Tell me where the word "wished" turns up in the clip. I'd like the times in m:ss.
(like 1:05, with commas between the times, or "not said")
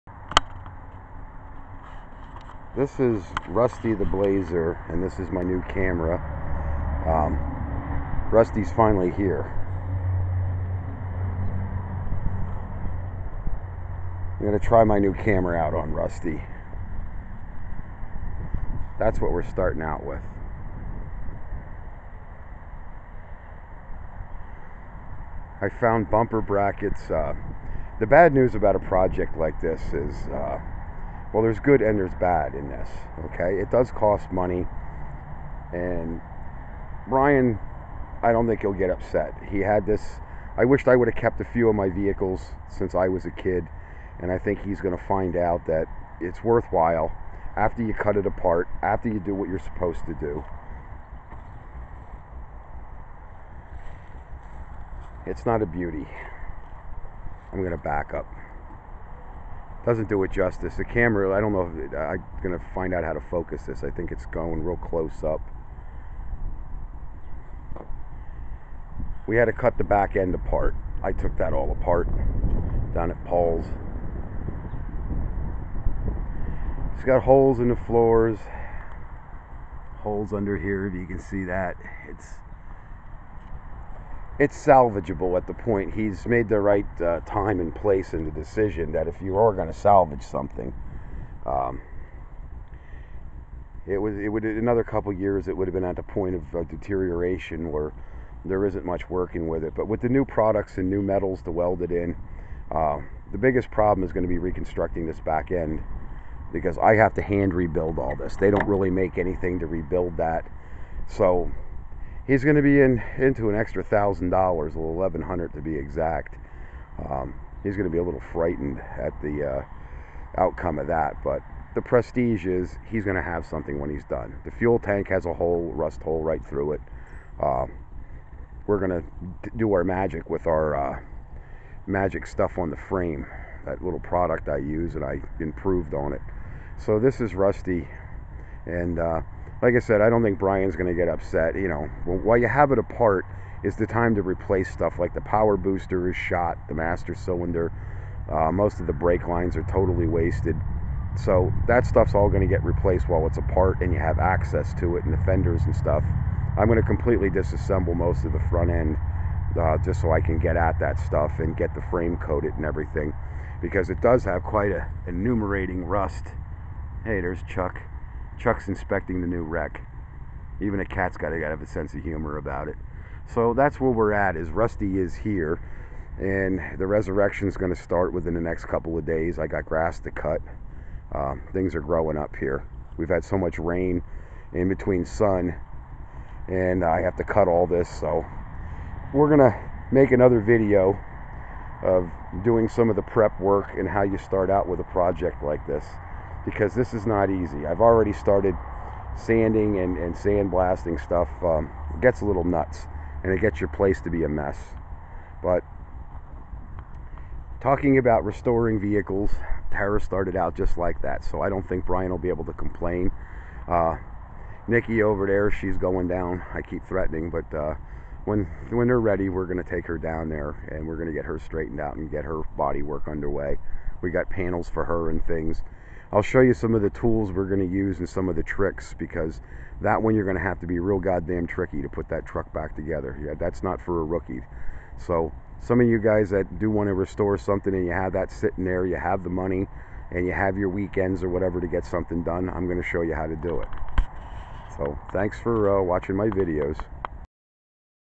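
0:40.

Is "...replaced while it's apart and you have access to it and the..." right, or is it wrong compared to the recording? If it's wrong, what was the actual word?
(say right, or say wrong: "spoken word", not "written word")
right.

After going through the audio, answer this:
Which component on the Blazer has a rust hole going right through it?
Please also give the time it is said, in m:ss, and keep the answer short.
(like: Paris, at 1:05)
The fuel tank, at 2:04.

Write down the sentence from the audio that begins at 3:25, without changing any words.
But talking about restoring vehicles, Tara started out just like that.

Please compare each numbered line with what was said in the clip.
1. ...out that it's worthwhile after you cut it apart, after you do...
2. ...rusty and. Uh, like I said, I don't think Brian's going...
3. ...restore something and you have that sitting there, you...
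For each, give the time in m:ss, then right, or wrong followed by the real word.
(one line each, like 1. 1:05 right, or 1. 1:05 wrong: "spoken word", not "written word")
1. 0:45 right
2. 2:17 right
3. 3:56 right.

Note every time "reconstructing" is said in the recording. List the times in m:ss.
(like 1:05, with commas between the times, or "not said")
1:44.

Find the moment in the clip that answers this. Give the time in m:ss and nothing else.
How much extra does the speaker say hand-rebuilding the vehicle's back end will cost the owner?
1:54.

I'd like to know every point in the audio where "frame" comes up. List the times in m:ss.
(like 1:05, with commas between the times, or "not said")
2:12, 2:41.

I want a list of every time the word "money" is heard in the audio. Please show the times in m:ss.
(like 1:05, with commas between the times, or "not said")
0:34, 3:59.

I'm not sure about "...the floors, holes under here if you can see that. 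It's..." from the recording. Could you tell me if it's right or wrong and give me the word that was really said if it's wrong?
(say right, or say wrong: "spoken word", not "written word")
right.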